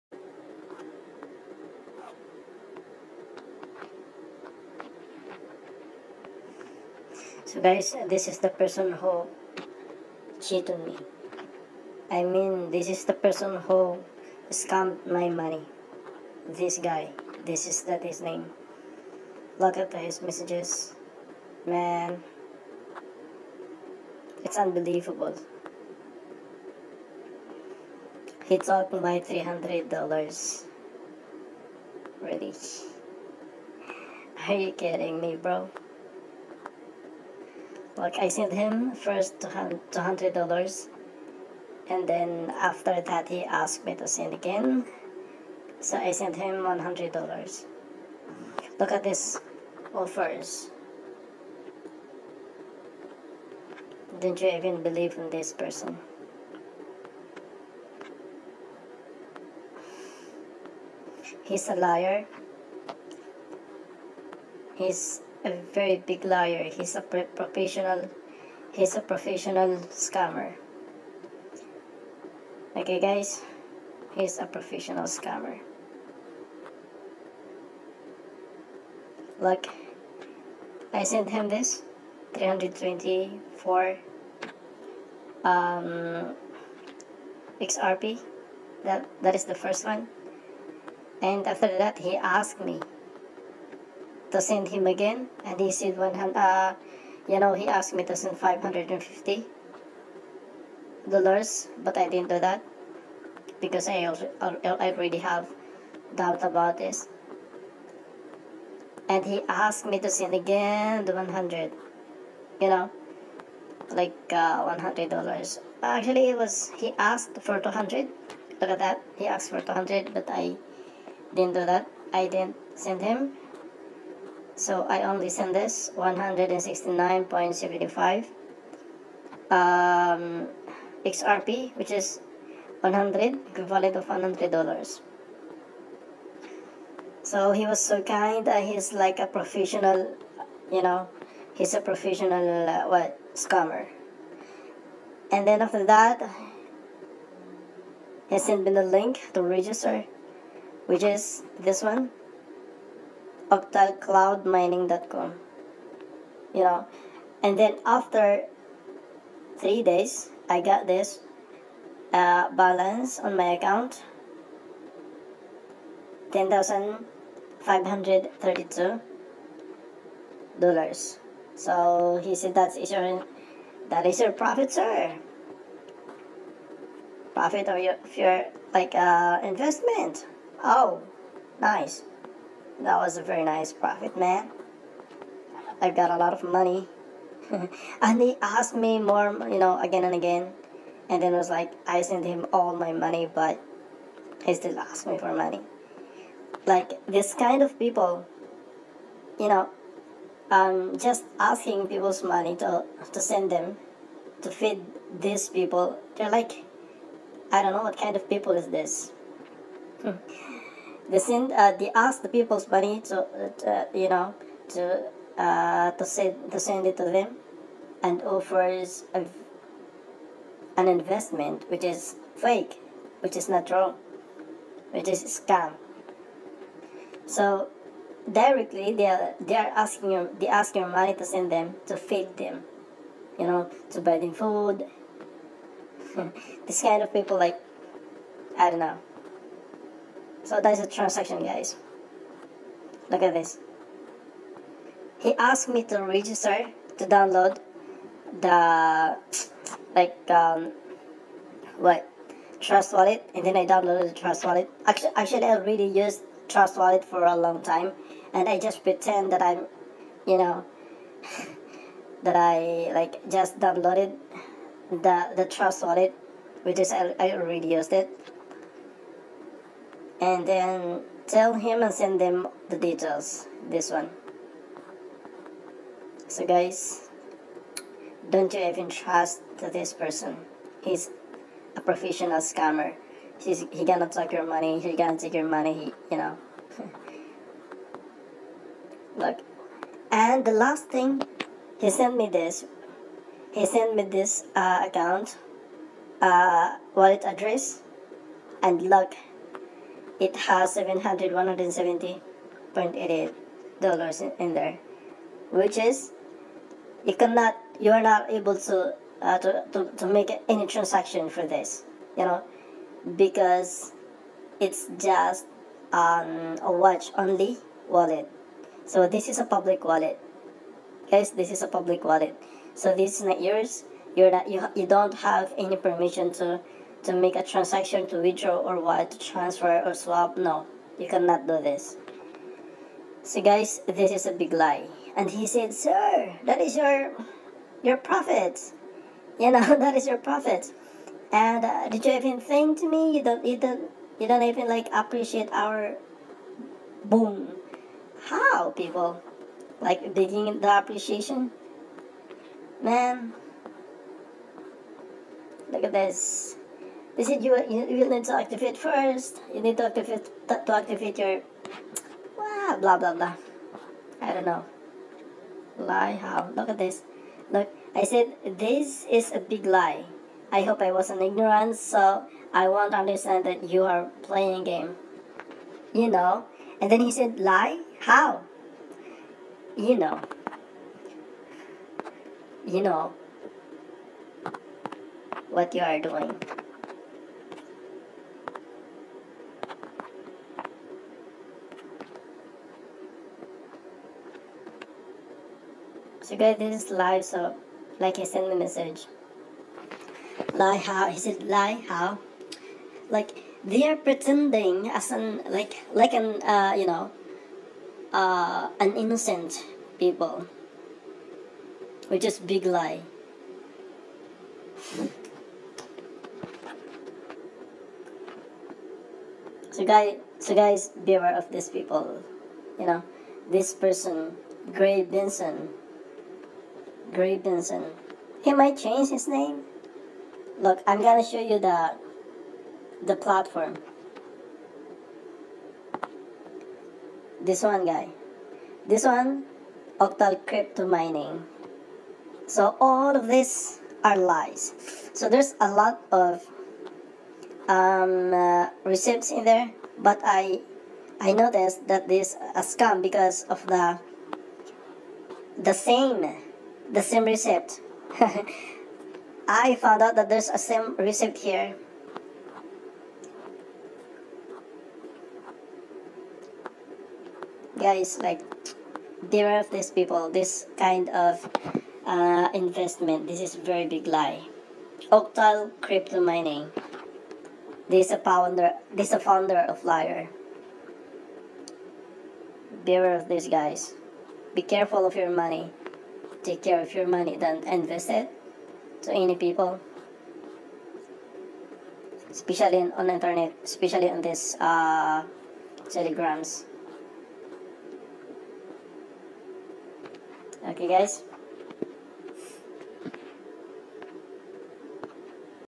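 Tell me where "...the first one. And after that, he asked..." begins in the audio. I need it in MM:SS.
01:29.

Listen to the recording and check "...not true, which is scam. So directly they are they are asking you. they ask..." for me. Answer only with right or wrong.
right.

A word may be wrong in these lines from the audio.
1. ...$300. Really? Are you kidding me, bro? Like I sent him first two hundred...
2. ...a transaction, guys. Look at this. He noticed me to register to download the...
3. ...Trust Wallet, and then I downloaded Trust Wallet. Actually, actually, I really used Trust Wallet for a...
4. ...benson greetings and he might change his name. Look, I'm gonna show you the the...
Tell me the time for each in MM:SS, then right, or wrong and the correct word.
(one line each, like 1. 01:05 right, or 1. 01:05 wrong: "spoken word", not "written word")
1. 00:29 right
2. 04:00 wrong: "asked", not "noticed"
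3. 04:12 right
4. 07:05 right.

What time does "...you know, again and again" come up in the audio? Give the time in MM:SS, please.
03:09.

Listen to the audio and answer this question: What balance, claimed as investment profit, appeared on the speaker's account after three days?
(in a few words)
10,532 dollars.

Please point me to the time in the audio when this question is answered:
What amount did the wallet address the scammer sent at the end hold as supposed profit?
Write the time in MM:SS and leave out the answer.
05:00.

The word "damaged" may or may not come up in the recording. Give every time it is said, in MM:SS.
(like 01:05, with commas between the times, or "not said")
not said.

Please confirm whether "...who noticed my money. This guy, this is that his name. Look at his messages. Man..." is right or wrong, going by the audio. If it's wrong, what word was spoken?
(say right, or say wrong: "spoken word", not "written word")
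wrong: "scammed", not "noticed".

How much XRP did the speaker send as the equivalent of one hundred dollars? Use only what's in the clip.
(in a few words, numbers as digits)
169.75.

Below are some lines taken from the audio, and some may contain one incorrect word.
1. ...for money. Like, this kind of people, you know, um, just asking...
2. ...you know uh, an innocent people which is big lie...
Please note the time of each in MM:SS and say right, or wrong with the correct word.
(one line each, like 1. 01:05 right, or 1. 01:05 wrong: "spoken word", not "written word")
1. 03:15 right
2. 06:46 right.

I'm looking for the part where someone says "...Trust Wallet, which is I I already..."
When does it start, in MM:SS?
04:25.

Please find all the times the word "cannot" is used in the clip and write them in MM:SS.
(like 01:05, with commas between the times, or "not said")
05:07, 05:31.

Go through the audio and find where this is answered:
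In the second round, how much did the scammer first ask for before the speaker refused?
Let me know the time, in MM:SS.
01:38.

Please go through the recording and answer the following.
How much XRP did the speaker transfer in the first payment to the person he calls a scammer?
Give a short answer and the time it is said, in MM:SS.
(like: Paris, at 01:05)
324, at 01:22.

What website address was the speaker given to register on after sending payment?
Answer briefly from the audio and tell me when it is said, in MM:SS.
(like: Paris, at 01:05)
octalcloudmining.com, at 02:33.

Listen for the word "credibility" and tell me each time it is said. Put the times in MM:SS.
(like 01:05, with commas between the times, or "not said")
not said.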